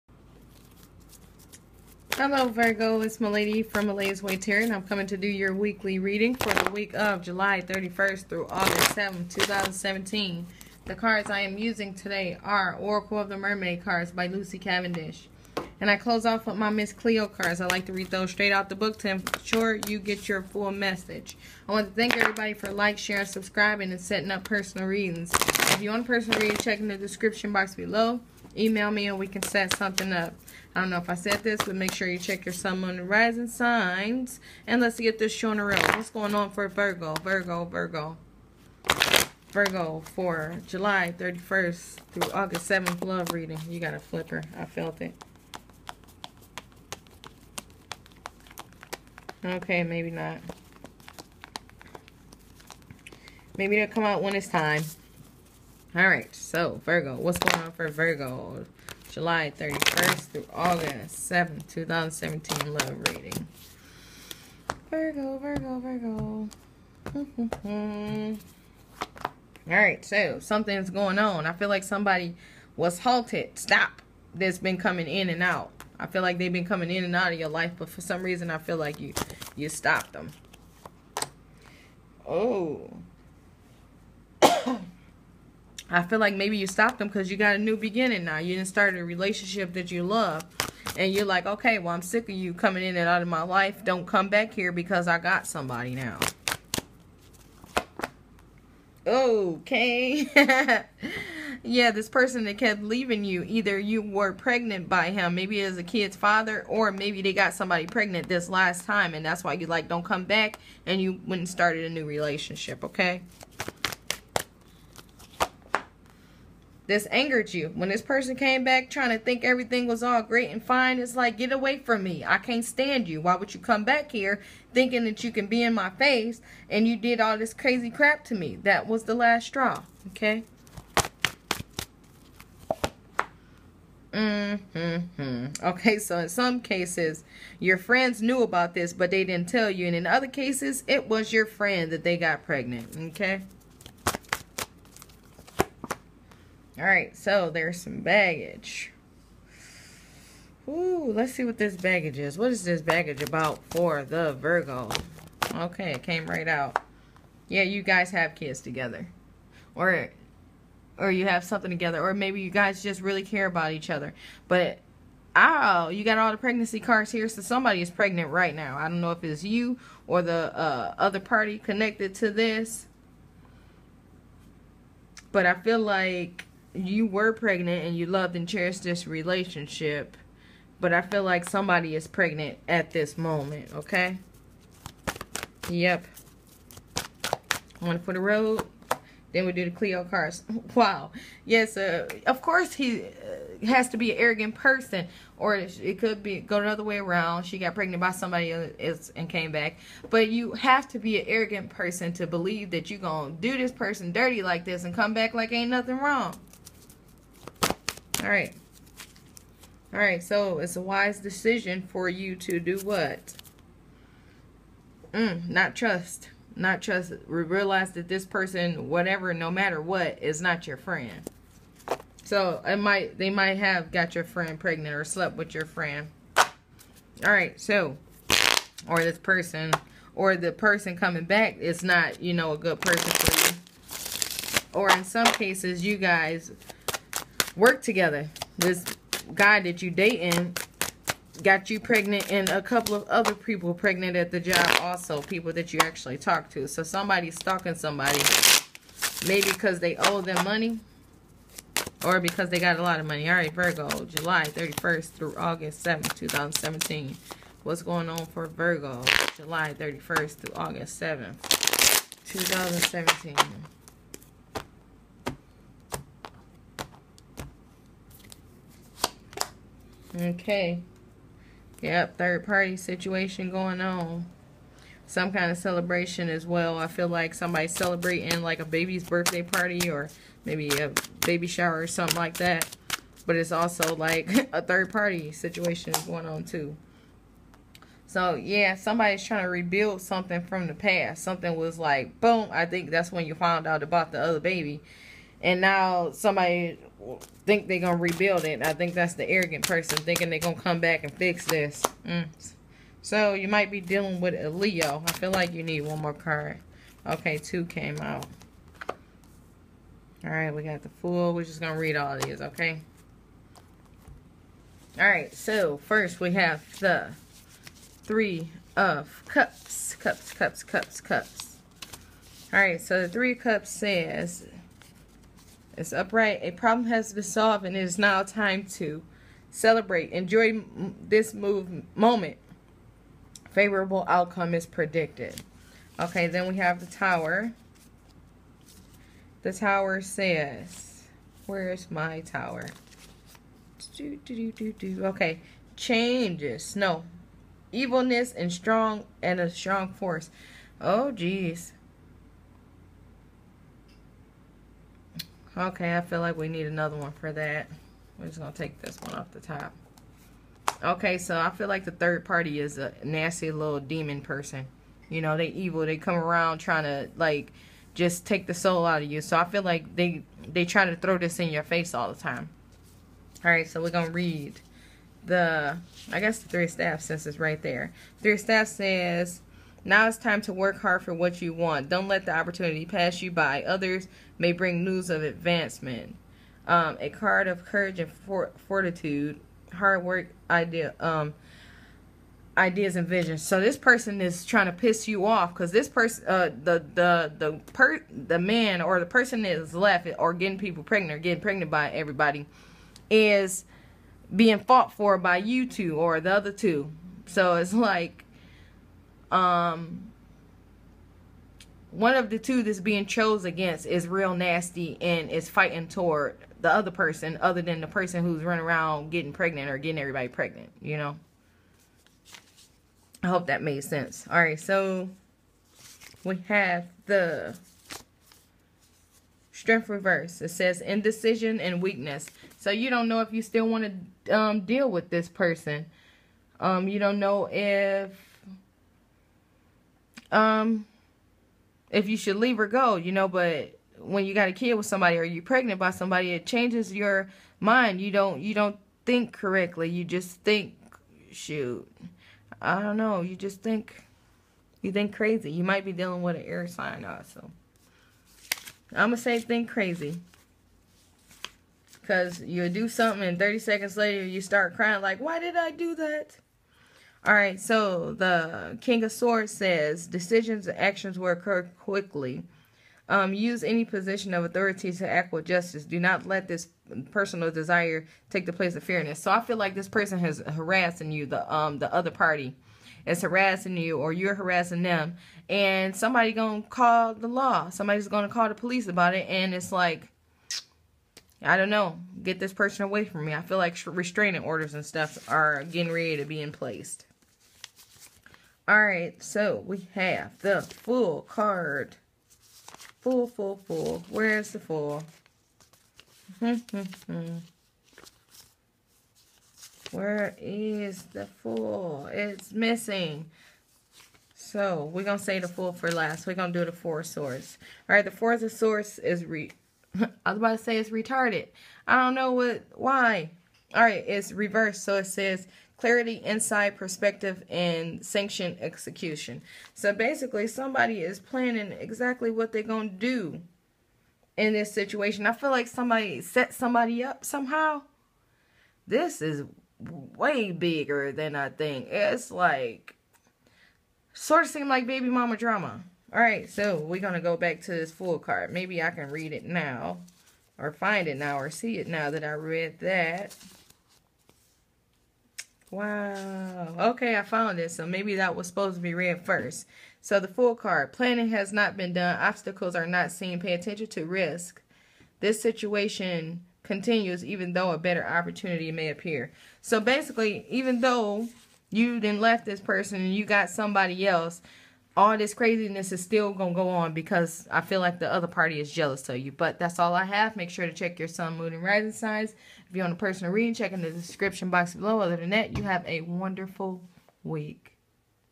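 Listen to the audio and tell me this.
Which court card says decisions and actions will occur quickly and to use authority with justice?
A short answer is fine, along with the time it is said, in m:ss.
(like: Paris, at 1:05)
King of Swords, at 7:48.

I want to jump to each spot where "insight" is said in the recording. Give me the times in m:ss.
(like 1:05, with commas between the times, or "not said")
8:46.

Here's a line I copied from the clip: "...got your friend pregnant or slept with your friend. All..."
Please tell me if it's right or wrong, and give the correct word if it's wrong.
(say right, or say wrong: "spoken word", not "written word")
right.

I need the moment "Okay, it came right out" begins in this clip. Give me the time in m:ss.
2:35.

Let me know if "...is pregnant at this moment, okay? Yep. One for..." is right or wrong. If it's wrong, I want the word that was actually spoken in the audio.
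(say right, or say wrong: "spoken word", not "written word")
right.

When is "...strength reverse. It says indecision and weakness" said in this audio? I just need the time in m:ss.
7:09.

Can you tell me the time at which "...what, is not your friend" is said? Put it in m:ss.
3:39.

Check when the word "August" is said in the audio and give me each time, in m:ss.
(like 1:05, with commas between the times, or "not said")
0:08, 0:42, 1:00, 4:15, 4:20.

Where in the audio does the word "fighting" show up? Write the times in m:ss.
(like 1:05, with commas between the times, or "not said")
6:55.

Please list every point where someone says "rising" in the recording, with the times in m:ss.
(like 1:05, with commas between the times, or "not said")
0:33, 9:41.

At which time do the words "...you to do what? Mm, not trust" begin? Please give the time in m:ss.
3:32.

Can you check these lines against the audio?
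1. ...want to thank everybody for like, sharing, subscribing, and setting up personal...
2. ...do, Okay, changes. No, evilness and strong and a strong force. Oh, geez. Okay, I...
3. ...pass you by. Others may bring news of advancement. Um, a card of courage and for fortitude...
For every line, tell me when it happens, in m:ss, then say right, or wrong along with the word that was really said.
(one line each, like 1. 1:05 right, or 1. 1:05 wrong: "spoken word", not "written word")
1. 0:21 right
2. 5:44 right
3. 6:22 right.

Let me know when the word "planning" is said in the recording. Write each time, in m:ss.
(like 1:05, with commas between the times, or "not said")
8:51, 9:20.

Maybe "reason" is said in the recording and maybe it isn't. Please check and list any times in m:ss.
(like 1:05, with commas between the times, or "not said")
1:18.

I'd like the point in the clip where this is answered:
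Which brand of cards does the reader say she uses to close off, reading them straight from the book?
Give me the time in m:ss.
0:16.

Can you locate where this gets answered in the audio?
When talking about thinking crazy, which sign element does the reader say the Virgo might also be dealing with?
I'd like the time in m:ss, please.
7:36.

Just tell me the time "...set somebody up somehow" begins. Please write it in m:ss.
8:56.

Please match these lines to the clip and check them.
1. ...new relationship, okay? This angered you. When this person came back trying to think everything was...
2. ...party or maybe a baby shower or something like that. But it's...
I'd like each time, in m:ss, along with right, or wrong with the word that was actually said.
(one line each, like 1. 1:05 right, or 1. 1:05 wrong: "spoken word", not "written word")
1. 1:51 right
2. 4:39 right.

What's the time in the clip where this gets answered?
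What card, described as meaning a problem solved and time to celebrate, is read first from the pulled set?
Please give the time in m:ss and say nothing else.
5:18.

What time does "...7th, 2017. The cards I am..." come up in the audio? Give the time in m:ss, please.
0:08.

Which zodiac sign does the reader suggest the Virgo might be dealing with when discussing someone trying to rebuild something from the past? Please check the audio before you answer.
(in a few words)
Leo.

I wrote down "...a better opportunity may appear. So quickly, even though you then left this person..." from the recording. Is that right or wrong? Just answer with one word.
wrong.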